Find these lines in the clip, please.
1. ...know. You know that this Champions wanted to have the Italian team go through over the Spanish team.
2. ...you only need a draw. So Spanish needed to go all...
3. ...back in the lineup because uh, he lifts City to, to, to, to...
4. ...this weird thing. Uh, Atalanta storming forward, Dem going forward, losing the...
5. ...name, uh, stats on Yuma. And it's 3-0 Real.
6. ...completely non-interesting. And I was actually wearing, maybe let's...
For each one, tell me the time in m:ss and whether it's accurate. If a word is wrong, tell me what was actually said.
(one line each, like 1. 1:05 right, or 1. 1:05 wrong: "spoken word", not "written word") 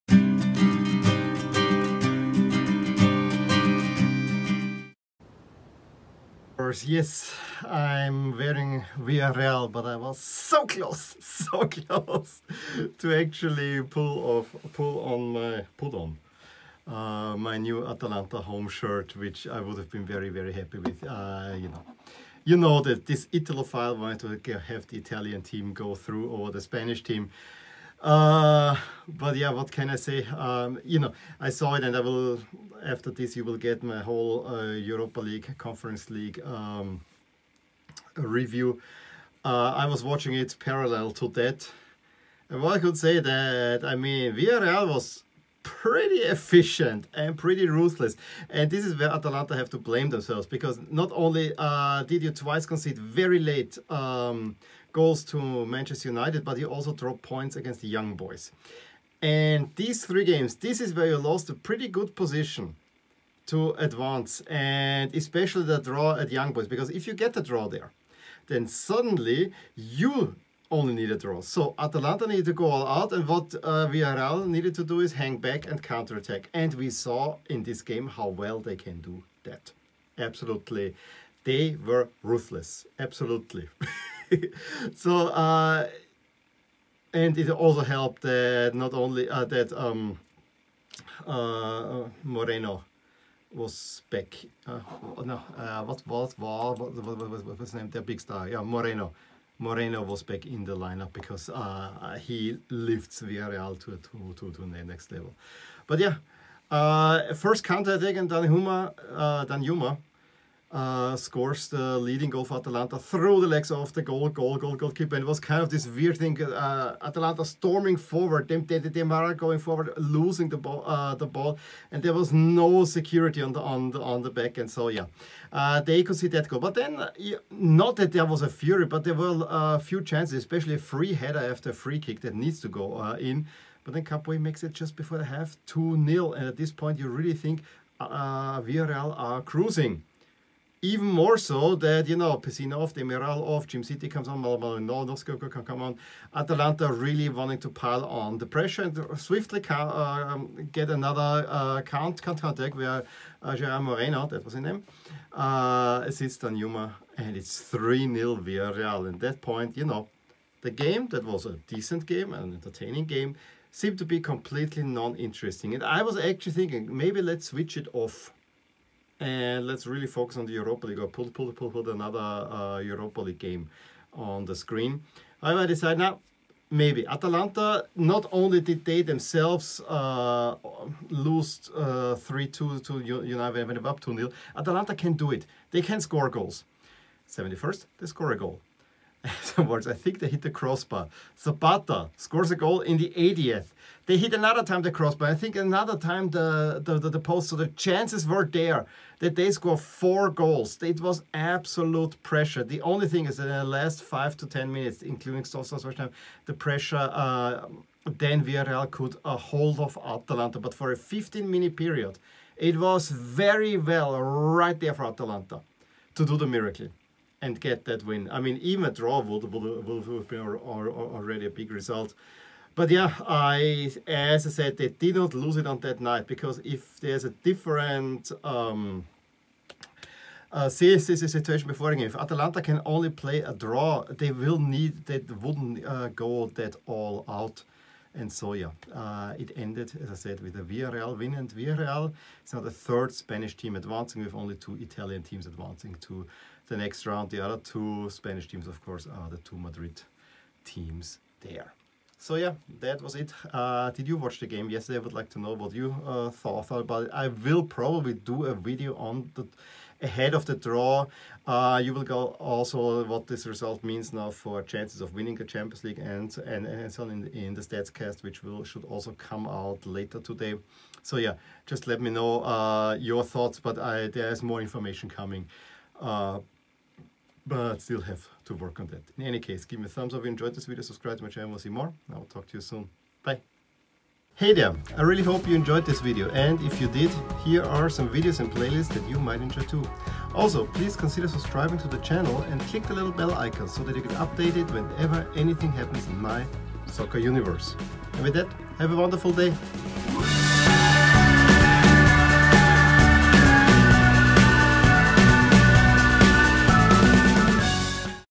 1. 0:21 wrong: "Italophile", not "Champions"
2. 1:09 wrong: "Atalanta", not "Spanish"
3. 1:40 wrong: "Villarreal", not "City"
4. 1:55 right
5. 2:34 wrong: "assists", not "stats"
6. 2:44 wrong: "thinking", not "wearing".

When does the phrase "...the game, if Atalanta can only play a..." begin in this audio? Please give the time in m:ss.
3:51.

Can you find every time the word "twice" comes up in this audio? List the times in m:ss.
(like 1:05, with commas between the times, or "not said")
0:52.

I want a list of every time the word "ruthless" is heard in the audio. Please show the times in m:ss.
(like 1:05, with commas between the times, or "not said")
0:47, 1:22.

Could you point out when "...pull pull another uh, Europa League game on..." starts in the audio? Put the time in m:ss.
2:51.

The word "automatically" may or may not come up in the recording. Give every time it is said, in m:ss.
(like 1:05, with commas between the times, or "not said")
not said.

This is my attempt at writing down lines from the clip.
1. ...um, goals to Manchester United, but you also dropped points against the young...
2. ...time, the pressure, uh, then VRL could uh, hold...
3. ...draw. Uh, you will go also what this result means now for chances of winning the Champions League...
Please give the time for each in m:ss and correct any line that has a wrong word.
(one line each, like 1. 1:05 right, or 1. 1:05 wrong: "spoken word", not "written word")
1. 0:53 right
2. 3:25 right
3. 4:20 right.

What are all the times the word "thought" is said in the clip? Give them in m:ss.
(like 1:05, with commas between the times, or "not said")
4:16, 4:33.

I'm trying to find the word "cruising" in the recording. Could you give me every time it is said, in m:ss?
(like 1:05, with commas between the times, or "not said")
2:19.